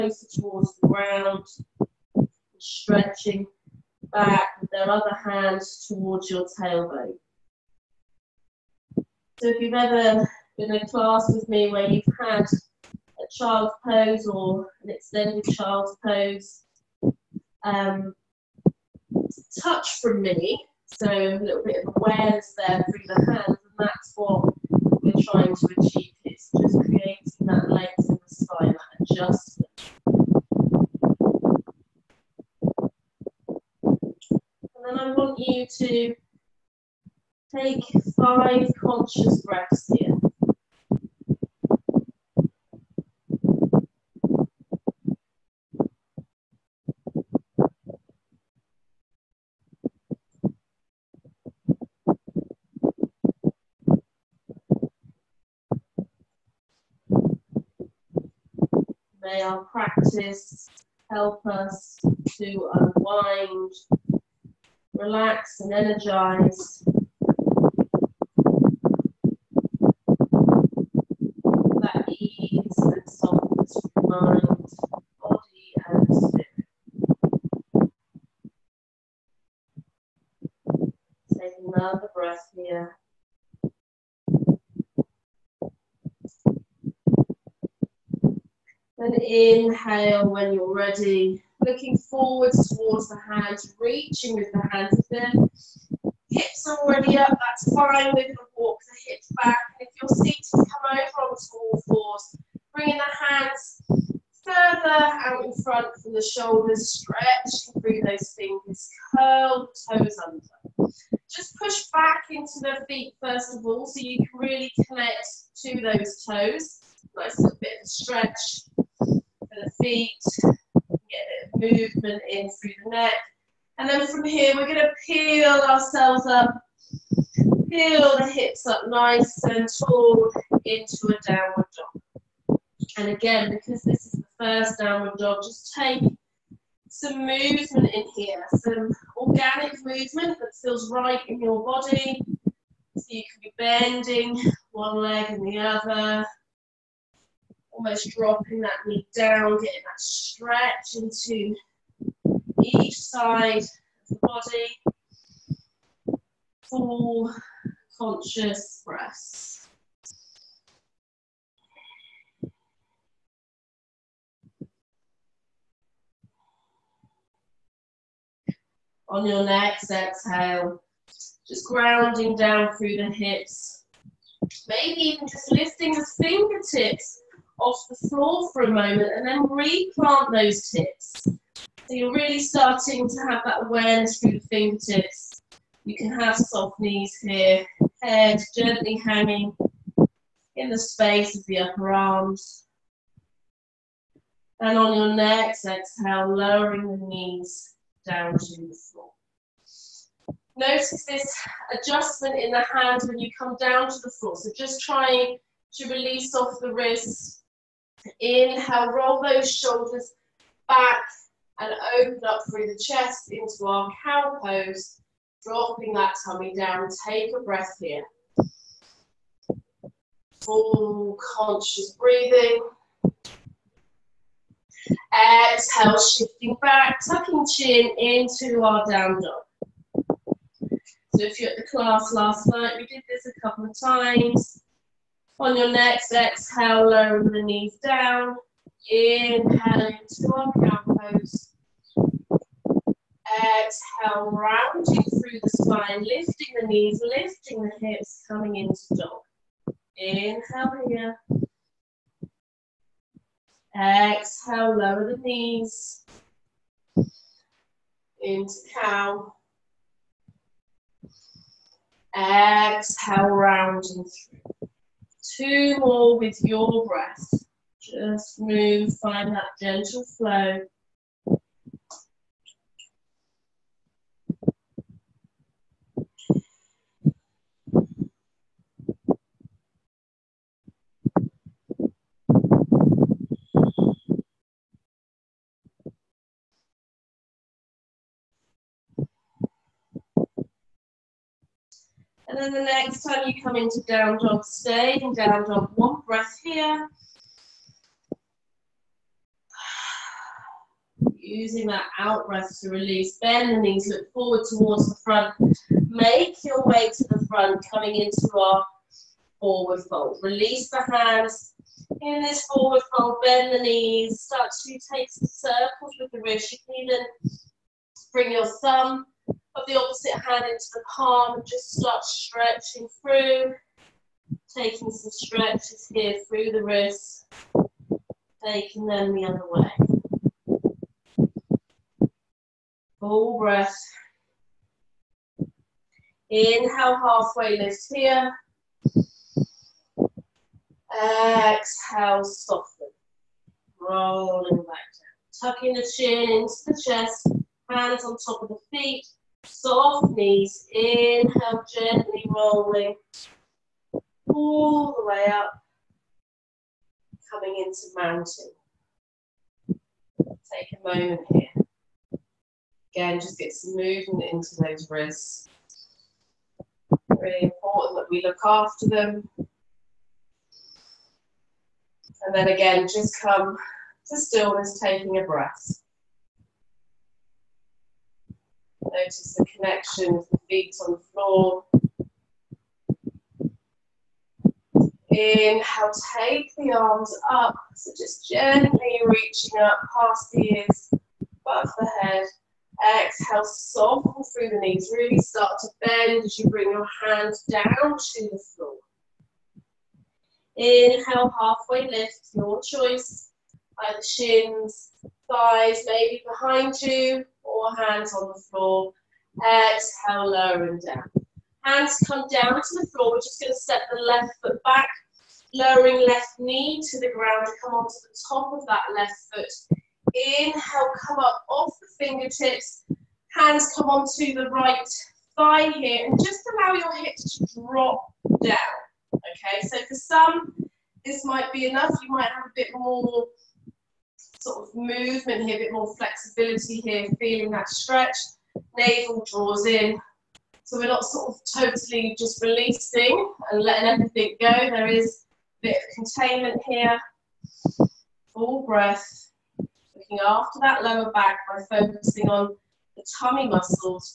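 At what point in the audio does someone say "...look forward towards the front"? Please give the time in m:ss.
5:03.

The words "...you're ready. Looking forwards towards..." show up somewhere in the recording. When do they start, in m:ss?
1:30.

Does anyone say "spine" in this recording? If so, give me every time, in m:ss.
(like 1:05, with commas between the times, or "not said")
0:28, 4:05.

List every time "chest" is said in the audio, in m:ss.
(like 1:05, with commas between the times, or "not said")
3:32, 5:46.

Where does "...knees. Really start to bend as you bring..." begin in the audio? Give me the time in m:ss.
6:34.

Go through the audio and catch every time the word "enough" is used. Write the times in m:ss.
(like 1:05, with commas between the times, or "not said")
7:11.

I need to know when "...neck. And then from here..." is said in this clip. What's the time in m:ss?
2:02.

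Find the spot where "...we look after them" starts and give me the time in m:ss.
6:08.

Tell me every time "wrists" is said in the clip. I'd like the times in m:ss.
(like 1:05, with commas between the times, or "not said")
3:26, 5:16, 5:26, 6:04.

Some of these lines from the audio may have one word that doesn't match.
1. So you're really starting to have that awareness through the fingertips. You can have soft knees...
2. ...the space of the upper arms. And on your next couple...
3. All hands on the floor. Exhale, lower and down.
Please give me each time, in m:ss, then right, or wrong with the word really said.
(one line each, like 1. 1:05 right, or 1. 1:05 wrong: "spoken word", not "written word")
1. 3:01 right
2. 3:10 wrong: "exhale", not "couple"
3. 6:47 right.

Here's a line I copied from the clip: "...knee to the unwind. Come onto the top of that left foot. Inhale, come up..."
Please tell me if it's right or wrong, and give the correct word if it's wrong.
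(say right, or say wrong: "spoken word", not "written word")
wrong: "ground", not "unwind".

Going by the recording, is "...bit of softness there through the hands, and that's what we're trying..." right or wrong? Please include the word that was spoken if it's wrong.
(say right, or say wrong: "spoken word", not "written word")
wrong: "awareness", not "softness".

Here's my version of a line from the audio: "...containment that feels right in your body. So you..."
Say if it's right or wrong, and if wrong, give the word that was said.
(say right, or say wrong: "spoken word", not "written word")
wrong: "movement", not "containment".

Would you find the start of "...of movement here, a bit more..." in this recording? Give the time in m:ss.
7:14.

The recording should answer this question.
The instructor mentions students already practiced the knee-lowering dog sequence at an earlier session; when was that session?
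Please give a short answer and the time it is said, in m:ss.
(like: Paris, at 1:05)
Last night, at 3:52.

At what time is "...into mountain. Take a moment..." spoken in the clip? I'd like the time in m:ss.
5:57.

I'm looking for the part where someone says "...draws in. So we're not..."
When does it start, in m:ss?
7:19.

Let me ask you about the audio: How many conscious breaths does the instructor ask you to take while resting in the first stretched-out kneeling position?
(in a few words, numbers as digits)
5.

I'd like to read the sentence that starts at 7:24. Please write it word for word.
There is a bit of containment here.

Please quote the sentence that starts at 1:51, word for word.
Just push back into the feet first of all so you can really connect to those toes.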